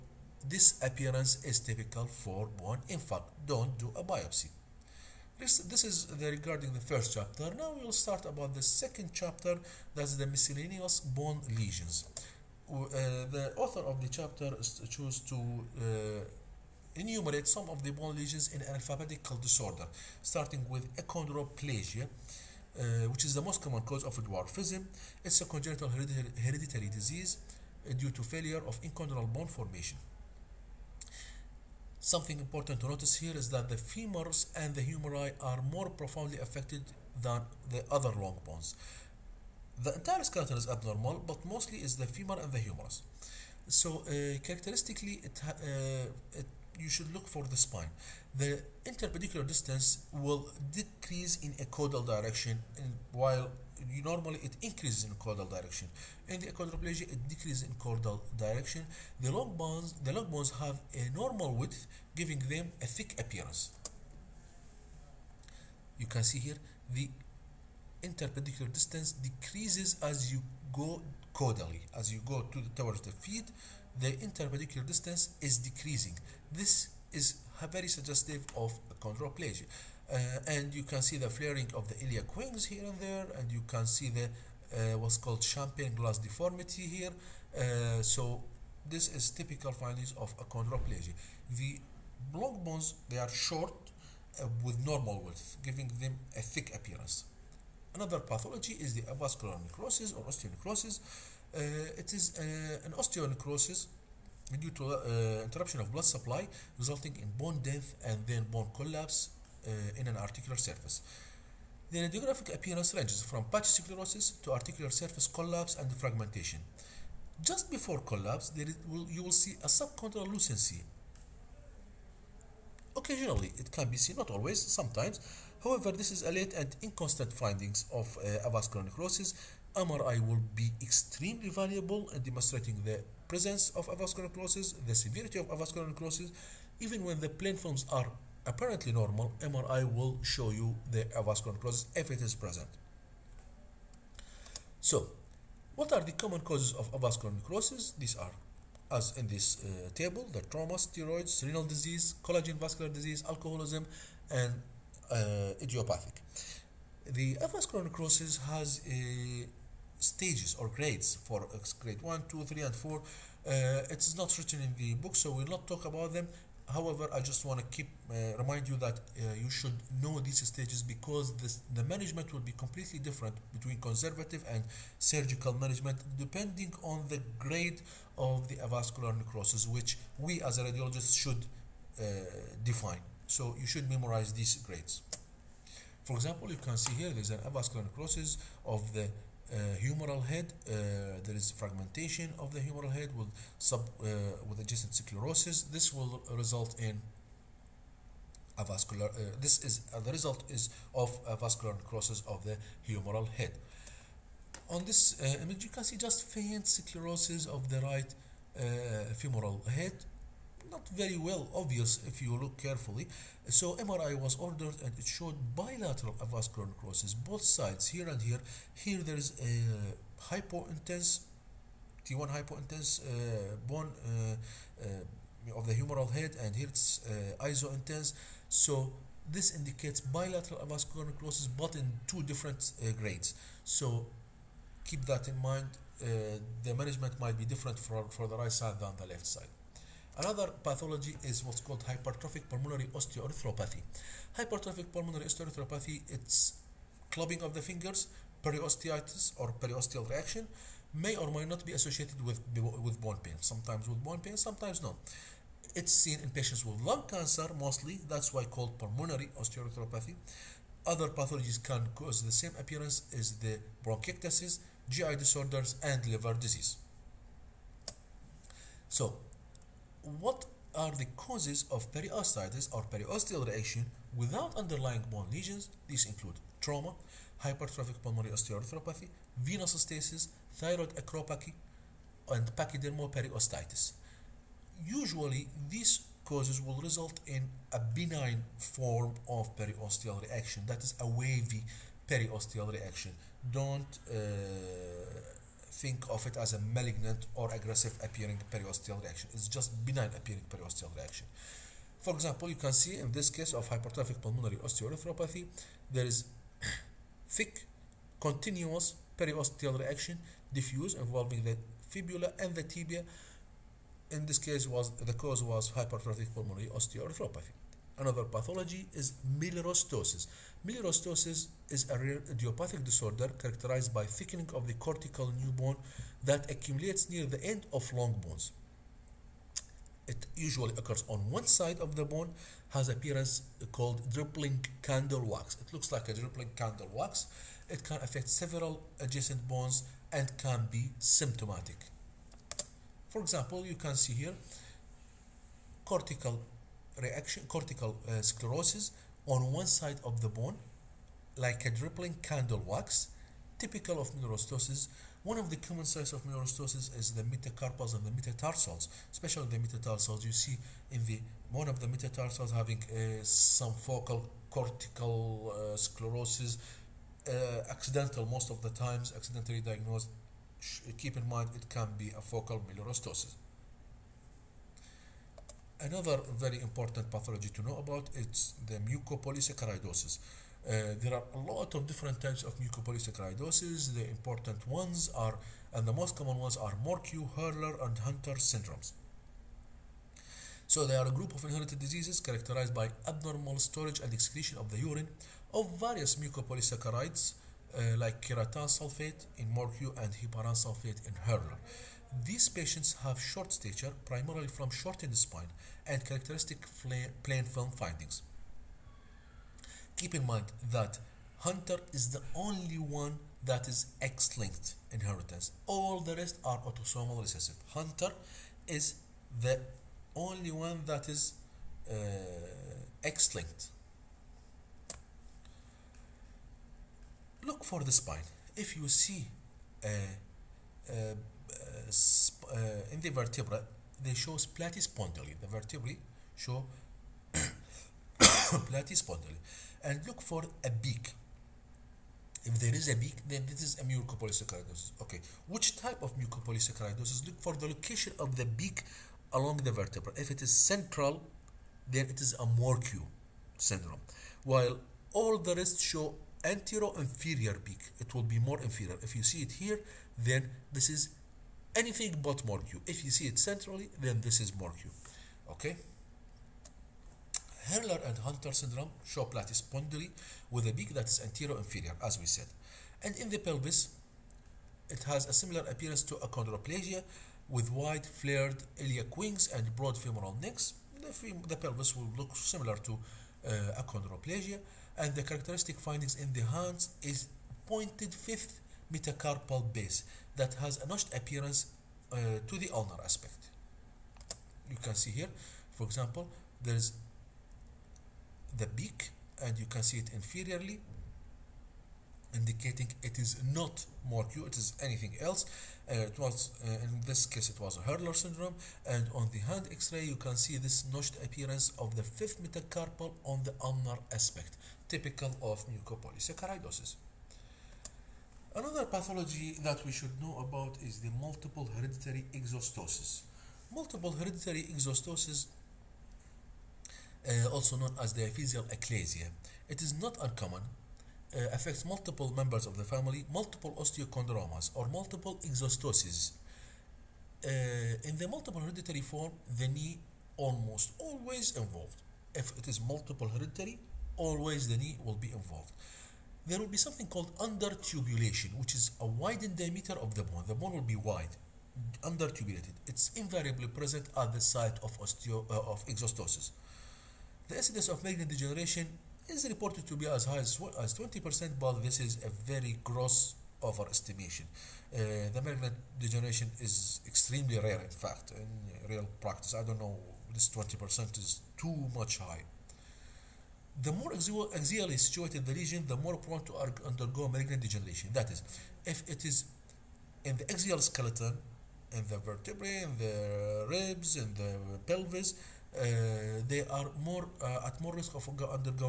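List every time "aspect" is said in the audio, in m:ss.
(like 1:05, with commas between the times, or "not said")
8:13, 8:34.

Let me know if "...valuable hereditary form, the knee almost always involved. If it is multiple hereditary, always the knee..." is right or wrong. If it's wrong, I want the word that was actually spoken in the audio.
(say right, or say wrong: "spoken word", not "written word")
wrong: "multiple", not "valuable".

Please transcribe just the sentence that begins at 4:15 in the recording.
It's seen in patients with lung cancer mostly, that's why called pulmonary osteoarthropathy.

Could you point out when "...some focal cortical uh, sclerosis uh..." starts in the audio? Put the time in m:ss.
6:03.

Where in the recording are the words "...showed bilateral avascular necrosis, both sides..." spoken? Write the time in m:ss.
3:35.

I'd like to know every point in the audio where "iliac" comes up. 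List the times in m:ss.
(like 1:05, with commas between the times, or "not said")
1:22, 7:58.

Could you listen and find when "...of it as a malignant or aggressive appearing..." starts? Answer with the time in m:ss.
4:56.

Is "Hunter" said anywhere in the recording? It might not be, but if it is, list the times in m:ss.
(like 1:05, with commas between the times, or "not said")
6:27, 6:51, 6:57, 7:48.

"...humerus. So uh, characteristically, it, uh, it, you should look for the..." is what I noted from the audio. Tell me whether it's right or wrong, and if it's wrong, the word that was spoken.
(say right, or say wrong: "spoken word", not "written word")
right.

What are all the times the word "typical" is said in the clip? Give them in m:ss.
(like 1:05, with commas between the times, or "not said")
0:01, 1:29, 5:53, 8:34.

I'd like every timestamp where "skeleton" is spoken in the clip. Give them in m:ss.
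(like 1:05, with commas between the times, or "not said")
0:40, 9:40.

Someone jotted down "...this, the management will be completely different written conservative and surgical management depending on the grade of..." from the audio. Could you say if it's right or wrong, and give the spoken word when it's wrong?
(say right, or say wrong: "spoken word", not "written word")
wrong: "between", not "written".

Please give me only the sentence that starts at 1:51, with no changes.
The radiographic appearance ranges from patchy sclerosis to articular surface collapse and fragmentation.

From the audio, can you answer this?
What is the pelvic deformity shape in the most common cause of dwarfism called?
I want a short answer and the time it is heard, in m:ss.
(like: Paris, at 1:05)
champagne glass deformity, at 1:25.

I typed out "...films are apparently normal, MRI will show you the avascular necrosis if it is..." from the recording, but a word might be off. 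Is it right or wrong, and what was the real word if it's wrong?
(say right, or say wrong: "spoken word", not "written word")
right.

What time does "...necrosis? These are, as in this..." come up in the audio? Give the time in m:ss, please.
2:27.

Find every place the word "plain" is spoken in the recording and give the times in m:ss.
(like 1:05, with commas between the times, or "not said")
2:17, 6:47.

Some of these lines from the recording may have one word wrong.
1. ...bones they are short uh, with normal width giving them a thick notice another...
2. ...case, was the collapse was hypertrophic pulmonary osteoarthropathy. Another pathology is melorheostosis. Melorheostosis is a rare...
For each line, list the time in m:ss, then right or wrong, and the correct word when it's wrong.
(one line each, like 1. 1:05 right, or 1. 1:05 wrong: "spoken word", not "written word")
1. 1:32 wrong: "appearance", not "notice"
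2. 5:14 wrong: "cause", not "collapse".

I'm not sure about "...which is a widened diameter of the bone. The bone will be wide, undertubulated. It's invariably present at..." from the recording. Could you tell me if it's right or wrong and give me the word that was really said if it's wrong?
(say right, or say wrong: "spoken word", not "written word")
right.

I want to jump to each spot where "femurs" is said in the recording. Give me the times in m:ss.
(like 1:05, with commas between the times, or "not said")
0:33, 0:42.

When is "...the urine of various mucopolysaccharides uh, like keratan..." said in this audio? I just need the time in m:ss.
6:34.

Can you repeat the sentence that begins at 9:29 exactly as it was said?
I don't know, this 20% is too much high the more axially situated the lesion, the more prone to undergo malignant degeneration.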